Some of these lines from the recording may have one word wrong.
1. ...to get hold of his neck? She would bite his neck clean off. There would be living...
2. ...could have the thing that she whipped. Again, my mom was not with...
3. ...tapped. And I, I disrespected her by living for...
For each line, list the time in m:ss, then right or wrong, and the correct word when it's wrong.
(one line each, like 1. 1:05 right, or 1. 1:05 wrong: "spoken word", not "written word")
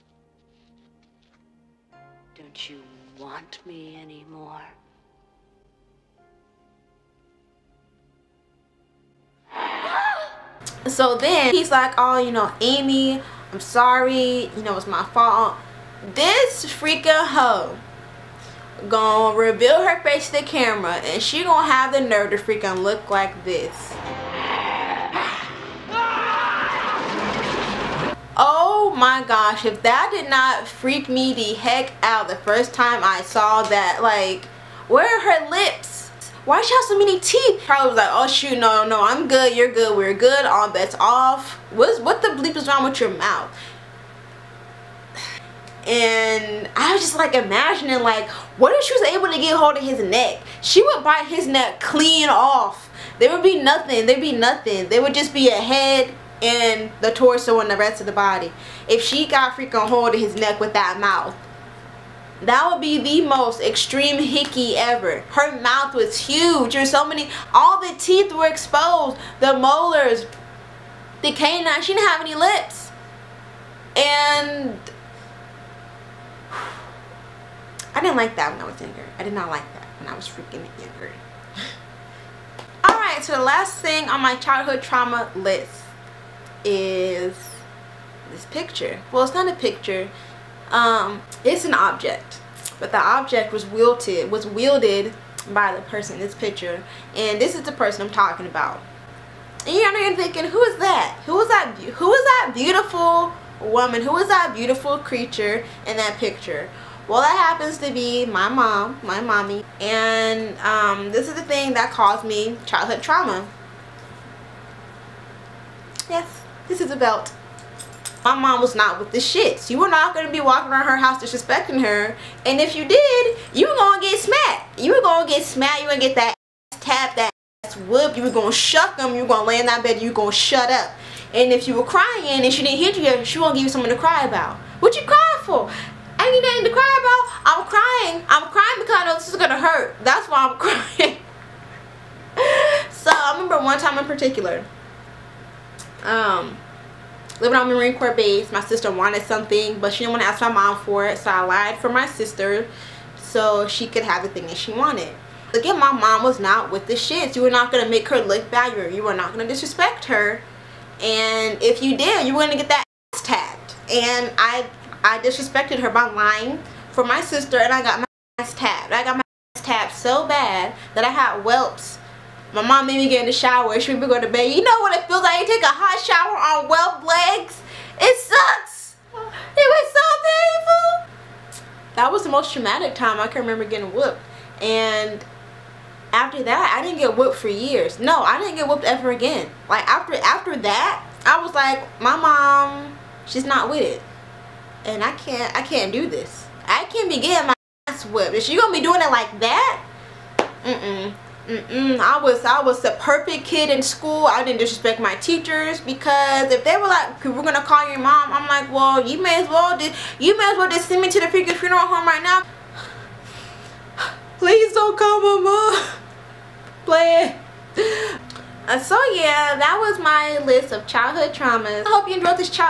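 1. 0:49 wrong: "nothing", not "living"
2. 2:33 wrong: "wanted", not "whipped"
3. 2:43 wrong: "lying", not "living".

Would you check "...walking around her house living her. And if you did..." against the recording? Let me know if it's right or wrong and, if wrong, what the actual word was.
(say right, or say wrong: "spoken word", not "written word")
wrong: "disrespecting", not "living".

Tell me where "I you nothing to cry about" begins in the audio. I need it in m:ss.
2:16.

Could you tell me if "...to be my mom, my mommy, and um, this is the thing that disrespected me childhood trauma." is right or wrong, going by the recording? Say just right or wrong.
wrong.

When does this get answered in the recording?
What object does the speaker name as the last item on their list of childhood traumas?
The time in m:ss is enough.
1:56.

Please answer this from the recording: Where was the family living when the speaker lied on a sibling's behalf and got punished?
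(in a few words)
Marine Corps base.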